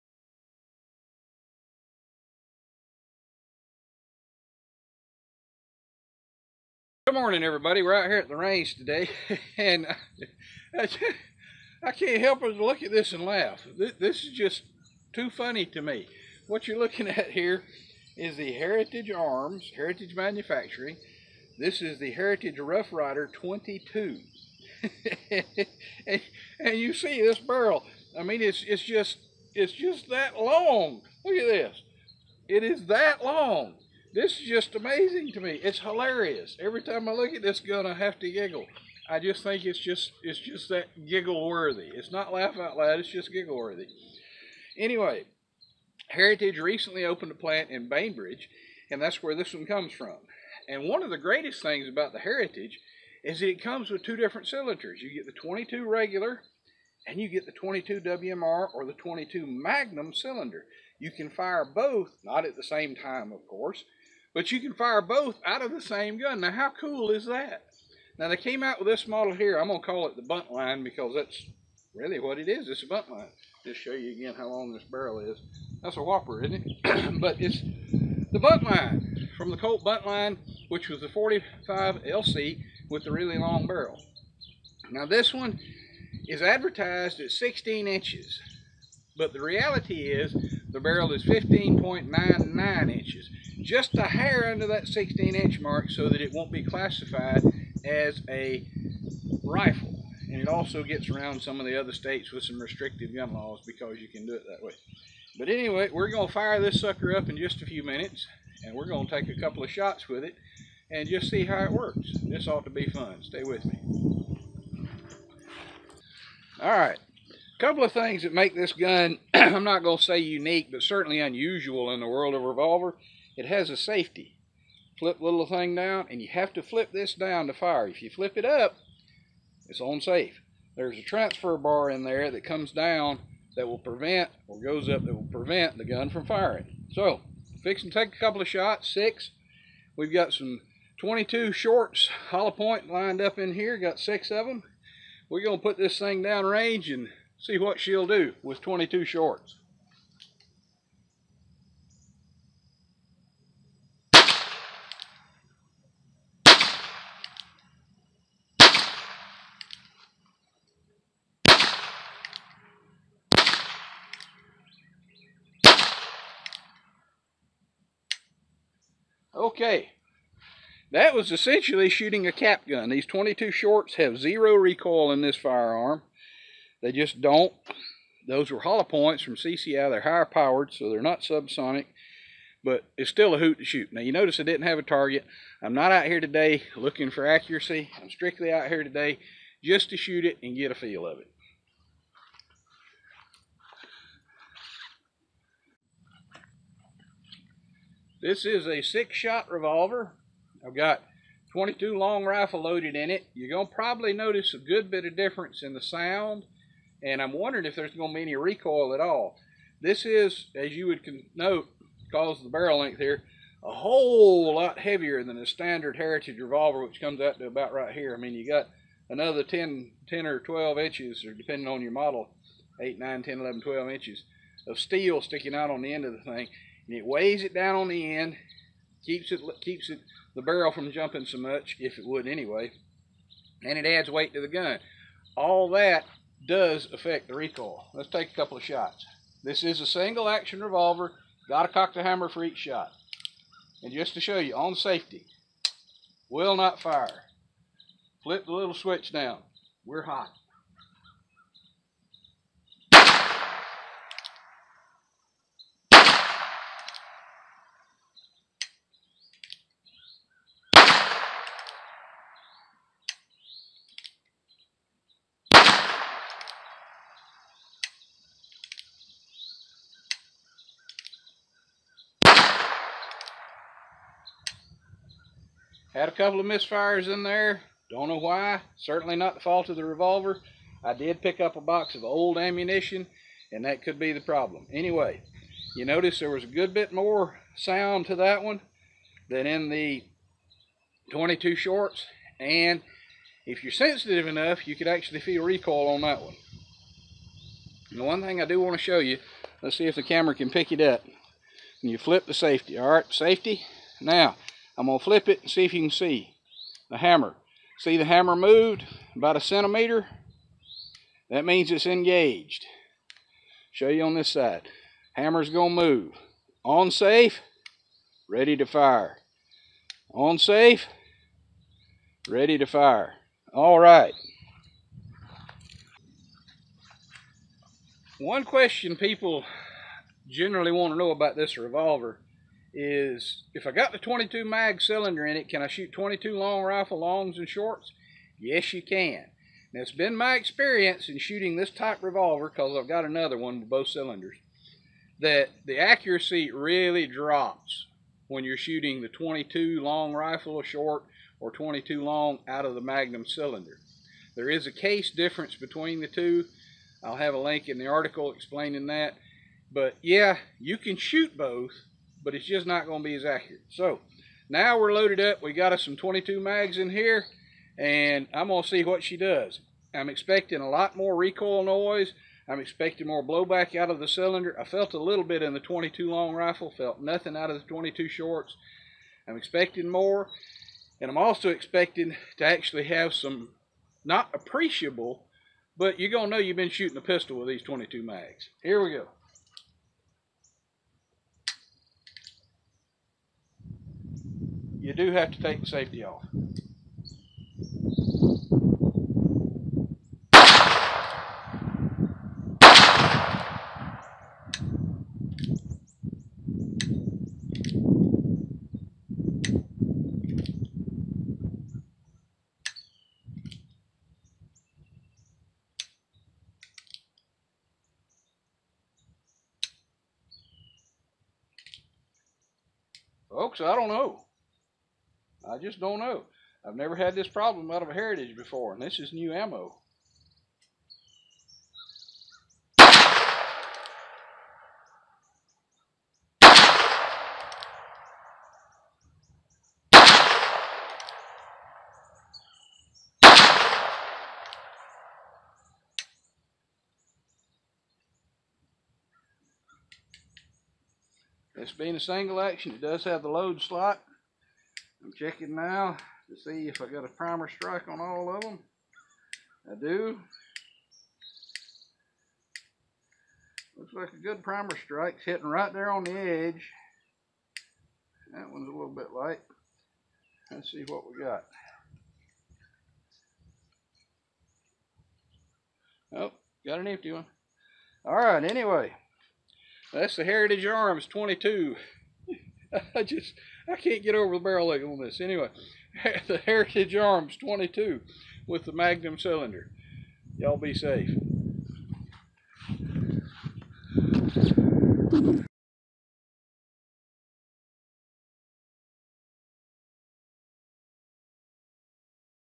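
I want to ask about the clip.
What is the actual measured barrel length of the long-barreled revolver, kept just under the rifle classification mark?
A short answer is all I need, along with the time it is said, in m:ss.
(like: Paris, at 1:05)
15.99 inches, at 1:31.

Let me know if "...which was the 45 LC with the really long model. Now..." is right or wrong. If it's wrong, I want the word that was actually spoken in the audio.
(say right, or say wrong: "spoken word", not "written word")
wrong: "barrel", not "model".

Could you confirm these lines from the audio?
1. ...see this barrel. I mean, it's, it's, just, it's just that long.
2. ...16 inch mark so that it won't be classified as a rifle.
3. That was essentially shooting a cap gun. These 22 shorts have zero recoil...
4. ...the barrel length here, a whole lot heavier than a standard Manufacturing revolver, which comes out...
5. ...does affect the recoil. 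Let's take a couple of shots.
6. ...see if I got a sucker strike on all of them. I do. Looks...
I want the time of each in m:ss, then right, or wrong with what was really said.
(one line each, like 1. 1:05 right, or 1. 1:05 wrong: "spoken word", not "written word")
1. 0:26 right
2. 1:34 right
3. 2:50 right
4. 3:32 wrong: "Heritage", not "Manufacturing"
5. 3:56 right
6. 7:36 wrong: "primer", not "sucker".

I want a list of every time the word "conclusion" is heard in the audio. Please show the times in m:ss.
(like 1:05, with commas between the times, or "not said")
not said.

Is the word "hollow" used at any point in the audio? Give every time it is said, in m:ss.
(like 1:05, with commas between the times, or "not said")
2:22, 2:58.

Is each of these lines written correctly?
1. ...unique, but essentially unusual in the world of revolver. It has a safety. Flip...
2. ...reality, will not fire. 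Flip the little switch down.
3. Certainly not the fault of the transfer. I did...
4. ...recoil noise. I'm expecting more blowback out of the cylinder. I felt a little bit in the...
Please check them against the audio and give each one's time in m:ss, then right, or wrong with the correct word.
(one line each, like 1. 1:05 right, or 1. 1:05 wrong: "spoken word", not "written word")
1. 2:00 wrong: "certainly", not "essentially"
2. 4:04 wrong: "safety", not "reality"
3. 4:38 wrong: "revolver", not "transfer"
4. 6:11 right.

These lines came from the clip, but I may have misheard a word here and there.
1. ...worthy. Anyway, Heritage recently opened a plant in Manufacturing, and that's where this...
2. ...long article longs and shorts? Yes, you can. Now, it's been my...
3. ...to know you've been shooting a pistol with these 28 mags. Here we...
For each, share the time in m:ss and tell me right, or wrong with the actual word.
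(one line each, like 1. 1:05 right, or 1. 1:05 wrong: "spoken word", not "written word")
1. 0:43 wrong: "Bainbridge", not "Manufacturing"
2. 5:36 wrong: "rifle", not "article"
3. 6:26 wrong: "22", not "28".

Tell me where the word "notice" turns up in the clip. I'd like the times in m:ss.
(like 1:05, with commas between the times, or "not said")
3:04, 3:24, 4:45.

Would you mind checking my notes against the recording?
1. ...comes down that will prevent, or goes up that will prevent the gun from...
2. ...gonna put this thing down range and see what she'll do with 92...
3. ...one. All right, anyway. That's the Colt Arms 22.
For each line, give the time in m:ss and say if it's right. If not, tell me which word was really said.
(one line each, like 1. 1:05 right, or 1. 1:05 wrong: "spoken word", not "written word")
1. 2:12 right
2. 2:25 wrong: "22", not "92"
3. 7:57 wrong: "Heritage", not "Colt".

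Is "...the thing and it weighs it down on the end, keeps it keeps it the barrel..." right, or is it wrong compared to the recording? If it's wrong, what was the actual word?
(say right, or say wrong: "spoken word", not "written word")
right.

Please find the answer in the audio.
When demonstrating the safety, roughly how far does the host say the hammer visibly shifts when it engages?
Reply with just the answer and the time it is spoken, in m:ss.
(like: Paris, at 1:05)
a centimeter, at 5:09.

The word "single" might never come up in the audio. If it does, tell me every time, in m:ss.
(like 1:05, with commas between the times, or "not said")
3:59, 7:31.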